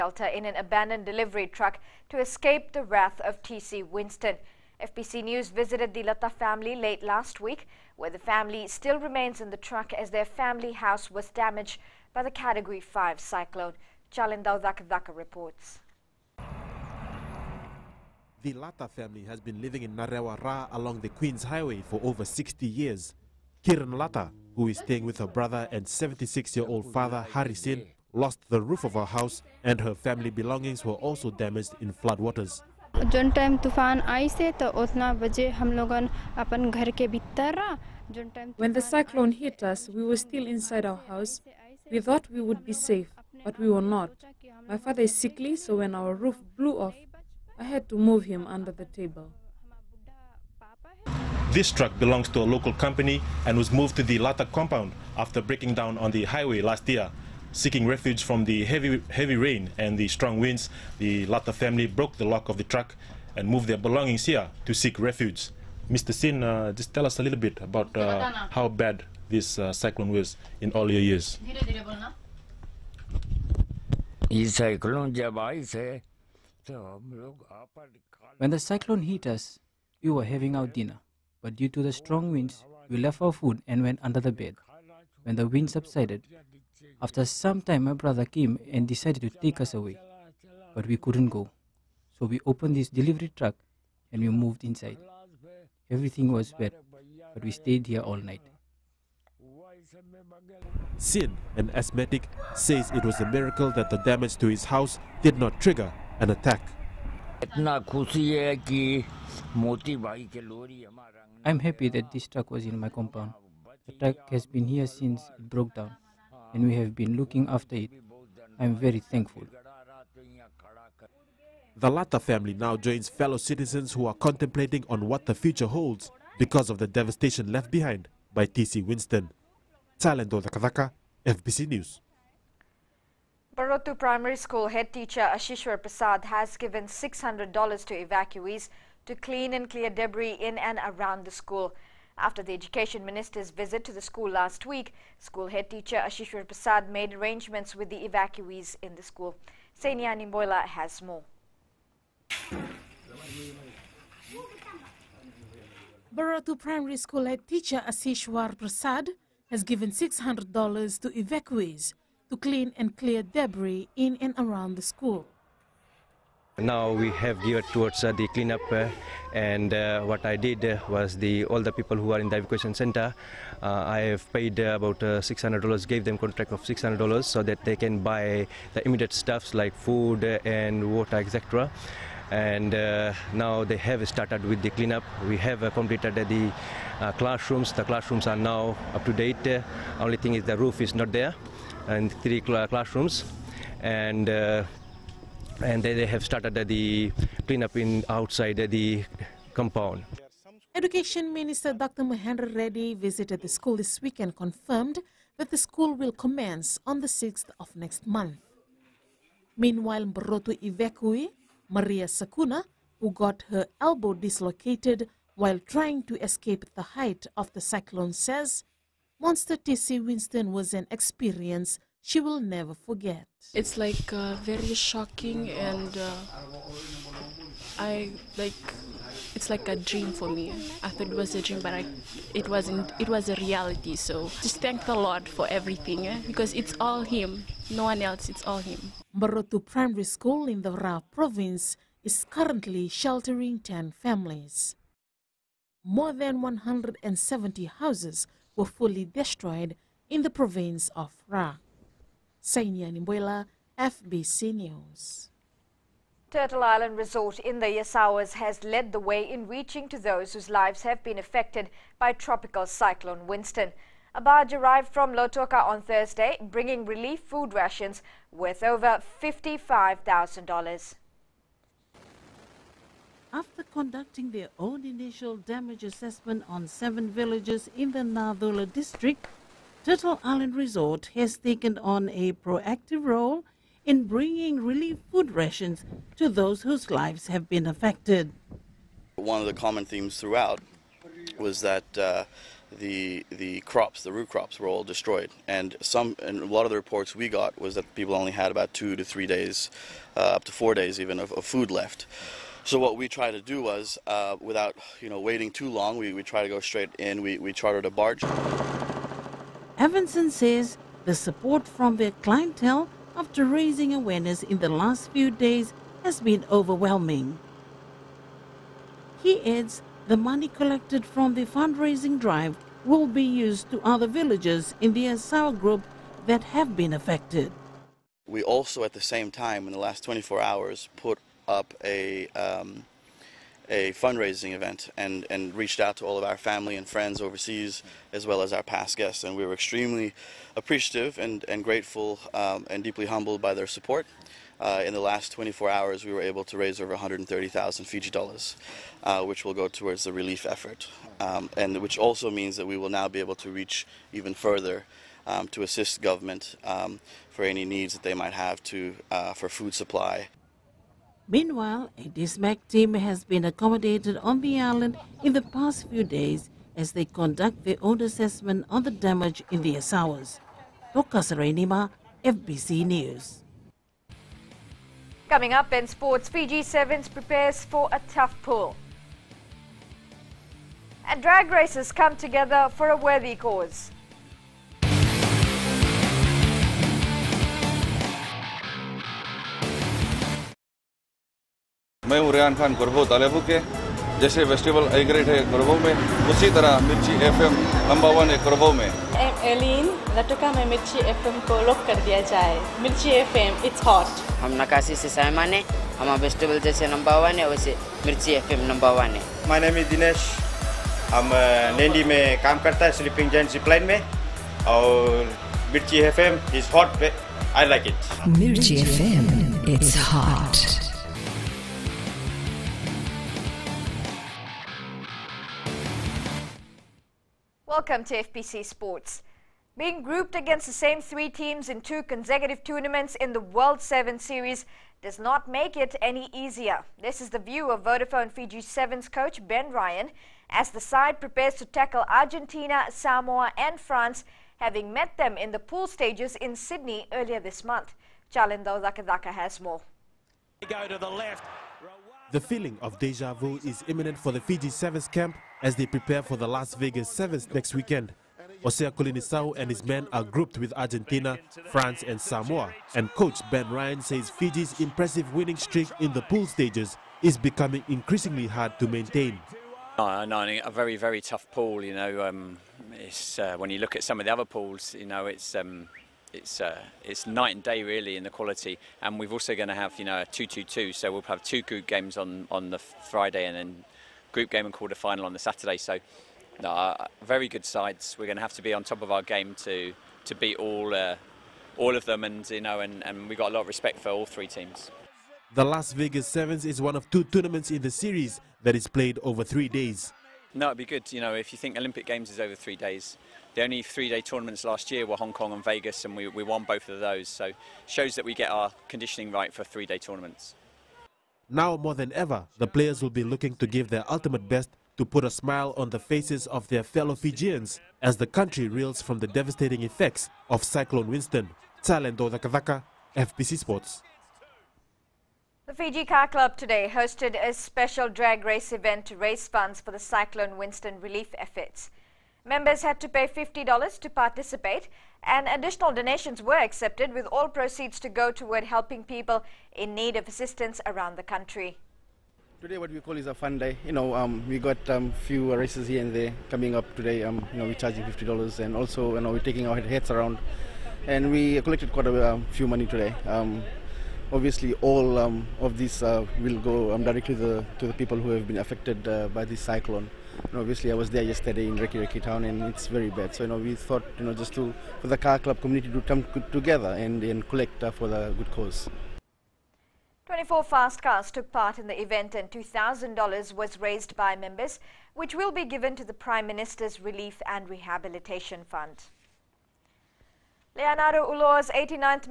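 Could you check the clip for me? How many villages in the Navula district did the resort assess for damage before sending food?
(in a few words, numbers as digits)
7.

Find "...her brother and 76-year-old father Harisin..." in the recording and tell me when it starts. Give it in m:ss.
0:25.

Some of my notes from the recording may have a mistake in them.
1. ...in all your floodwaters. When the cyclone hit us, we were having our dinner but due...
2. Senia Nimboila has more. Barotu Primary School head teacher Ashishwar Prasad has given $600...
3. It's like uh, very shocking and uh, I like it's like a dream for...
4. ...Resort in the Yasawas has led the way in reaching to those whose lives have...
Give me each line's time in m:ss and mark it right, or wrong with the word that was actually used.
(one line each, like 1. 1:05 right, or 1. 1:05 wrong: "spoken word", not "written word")
1. 1:10 wrong: "years", not "floodwaters"
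2. 2:29 right
3. 3:43 right
4. 4:16 right.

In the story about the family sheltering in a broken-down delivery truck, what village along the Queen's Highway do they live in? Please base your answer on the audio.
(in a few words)
Narewa Ra.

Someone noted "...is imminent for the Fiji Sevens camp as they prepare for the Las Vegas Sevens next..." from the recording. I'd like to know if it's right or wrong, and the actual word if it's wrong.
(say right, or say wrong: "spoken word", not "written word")
right.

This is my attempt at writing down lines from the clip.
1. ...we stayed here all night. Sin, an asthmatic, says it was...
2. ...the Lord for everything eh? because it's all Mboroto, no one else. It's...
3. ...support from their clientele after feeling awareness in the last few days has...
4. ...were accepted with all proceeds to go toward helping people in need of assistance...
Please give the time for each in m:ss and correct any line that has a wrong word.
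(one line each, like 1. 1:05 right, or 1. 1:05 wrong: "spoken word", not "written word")
1. 1:37 right
2. 3:54 wrong: "Him", not "Mboroto"
3. 5:11 wrong: "raising", not "feeling"
4. 8:56 right.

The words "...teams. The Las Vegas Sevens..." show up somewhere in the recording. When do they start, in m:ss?
8:14.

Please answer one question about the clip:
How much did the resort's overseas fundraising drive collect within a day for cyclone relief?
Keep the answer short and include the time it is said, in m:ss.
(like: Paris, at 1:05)
130,000 Fiji dollars, at 5:46.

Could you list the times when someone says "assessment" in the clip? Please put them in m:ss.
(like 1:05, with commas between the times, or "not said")
4:35, 6:08.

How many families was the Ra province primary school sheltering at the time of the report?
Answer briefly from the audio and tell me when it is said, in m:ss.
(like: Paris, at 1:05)
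10, at 4:03.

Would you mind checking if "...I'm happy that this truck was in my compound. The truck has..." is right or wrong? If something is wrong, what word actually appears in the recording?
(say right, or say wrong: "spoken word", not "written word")
right.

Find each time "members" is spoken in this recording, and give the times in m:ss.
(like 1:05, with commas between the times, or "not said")
8:52, 9:34.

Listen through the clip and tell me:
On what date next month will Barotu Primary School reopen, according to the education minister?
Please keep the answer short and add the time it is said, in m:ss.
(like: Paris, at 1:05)
6th, at 3:27.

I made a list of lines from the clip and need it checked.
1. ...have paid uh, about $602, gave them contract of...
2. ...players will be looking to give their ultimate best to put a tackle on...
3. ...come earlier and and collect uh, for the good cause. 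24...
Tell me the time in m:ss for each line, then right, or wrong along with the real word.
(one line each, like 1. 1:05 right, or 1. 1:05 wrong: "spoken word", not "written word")
1. 2:54 wrong: "600", not "602"
2. 8:32 wrong: "smile", not "tackle"
3. 9:26 wrong: "together", not "earlier".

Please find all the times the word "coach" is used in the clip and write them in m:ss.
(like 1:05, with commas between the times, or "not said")
7:19, 7:43.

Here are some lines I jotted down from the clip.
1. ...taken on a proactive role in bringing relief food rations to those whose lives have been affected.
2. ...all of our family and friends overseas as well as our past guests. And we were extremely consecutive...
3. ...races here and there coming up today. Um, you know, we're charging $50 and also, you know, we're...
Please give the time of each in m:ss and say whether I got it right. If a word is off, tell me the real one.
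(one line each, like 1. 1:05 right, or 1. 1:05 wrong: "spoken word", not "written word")
1. 4:41 right
2. 5:36 wrong: "appreciative", not "consecutive"
3. 9:05 right.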